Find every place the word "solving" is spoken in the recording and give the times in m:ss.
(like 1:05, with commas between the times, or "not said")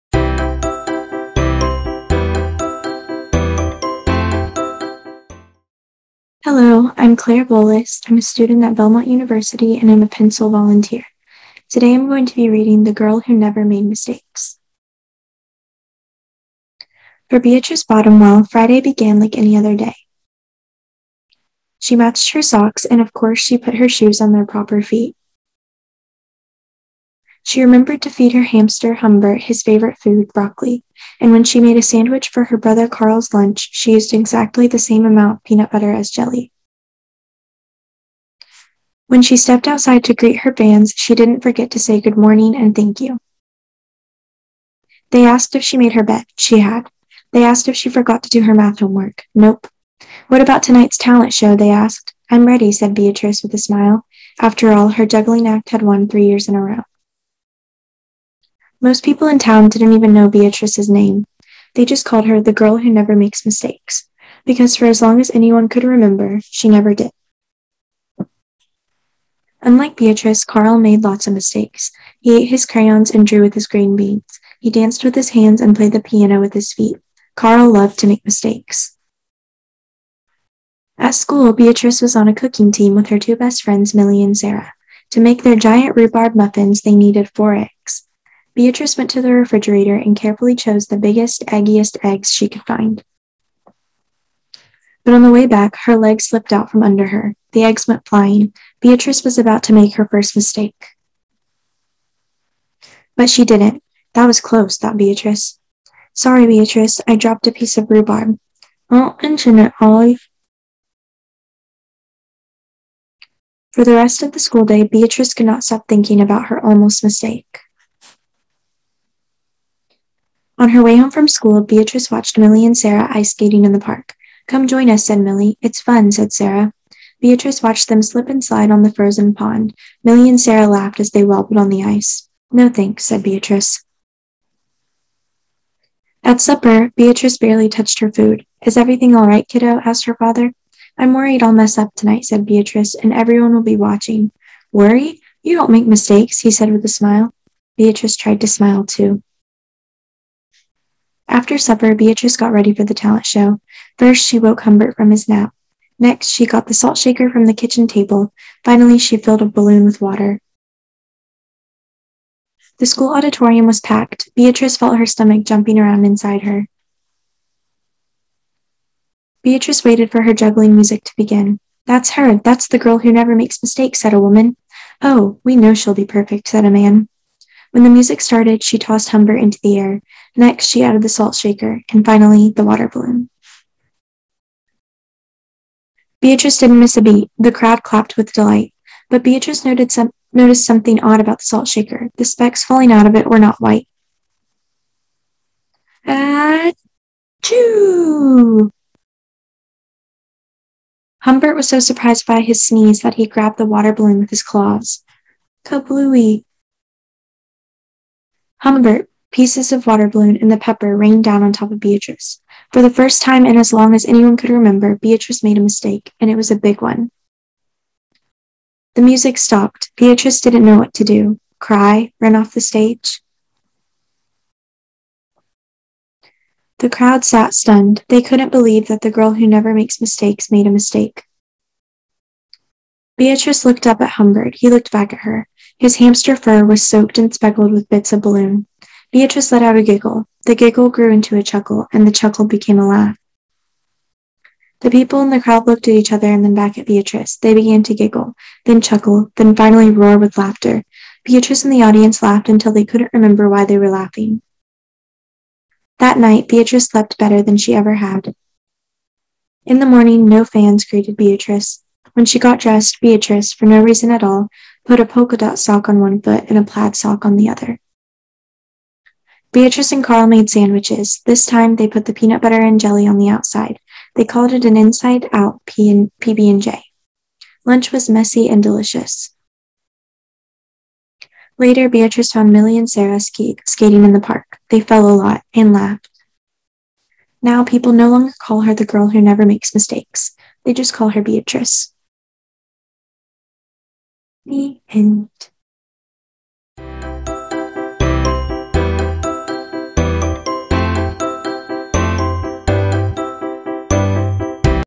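not said.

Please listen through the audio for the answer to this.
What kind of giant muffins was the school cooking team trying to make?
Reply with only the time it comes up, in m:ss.
1:25.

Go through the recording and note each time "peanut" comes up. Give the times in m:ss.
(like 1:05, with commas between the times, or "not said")
0:35, 4:32.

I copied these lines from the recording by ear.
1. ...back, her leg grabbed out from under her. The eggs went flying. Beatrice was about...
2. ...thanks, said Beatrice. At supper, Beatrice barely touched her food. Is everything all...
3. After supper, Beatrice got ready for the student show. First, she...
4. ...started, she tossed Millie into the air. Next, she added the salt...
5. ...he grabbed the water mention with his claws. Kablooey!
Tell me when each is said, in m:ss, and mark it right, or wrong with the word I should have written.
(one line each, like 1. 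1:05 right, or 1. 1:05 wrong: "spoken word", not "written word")
1. 1:35 wrong: "slipped", not "grabbed"
2. 2:12 right
3. 2:31 wrong: "talent", not "student"
4. 2:58 wrong: "Humbert", not "Millie"
5. 3:23 wrong: "balloon", not "mention".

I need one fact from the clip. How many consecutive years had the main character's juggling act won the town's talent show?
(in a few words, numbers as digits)
3.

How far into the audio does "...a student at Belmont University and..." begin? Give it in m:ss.
0:08.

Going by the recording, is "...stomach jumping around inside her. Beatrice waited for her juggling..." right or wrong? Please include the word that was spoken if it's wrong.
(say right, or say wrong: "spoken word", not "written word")
right.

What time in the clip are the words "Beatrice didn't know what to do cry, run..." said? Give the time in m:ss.
3:39.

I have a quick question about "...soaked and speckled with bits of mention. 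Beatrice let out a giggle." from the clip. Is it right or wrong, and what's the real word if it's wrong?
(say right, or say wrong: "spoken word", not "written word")
wrong: "balloon", not "mention".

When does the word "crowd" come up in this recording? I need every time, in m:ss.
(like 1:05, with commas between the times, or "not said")
3:07, 3:46, 4:05.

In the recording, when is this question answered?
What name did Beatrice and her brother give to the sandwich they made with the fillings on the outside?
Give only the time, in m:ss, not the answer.
4:34.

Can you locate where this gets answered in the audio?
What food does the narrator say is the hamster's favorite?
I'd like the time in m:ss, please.
0:30.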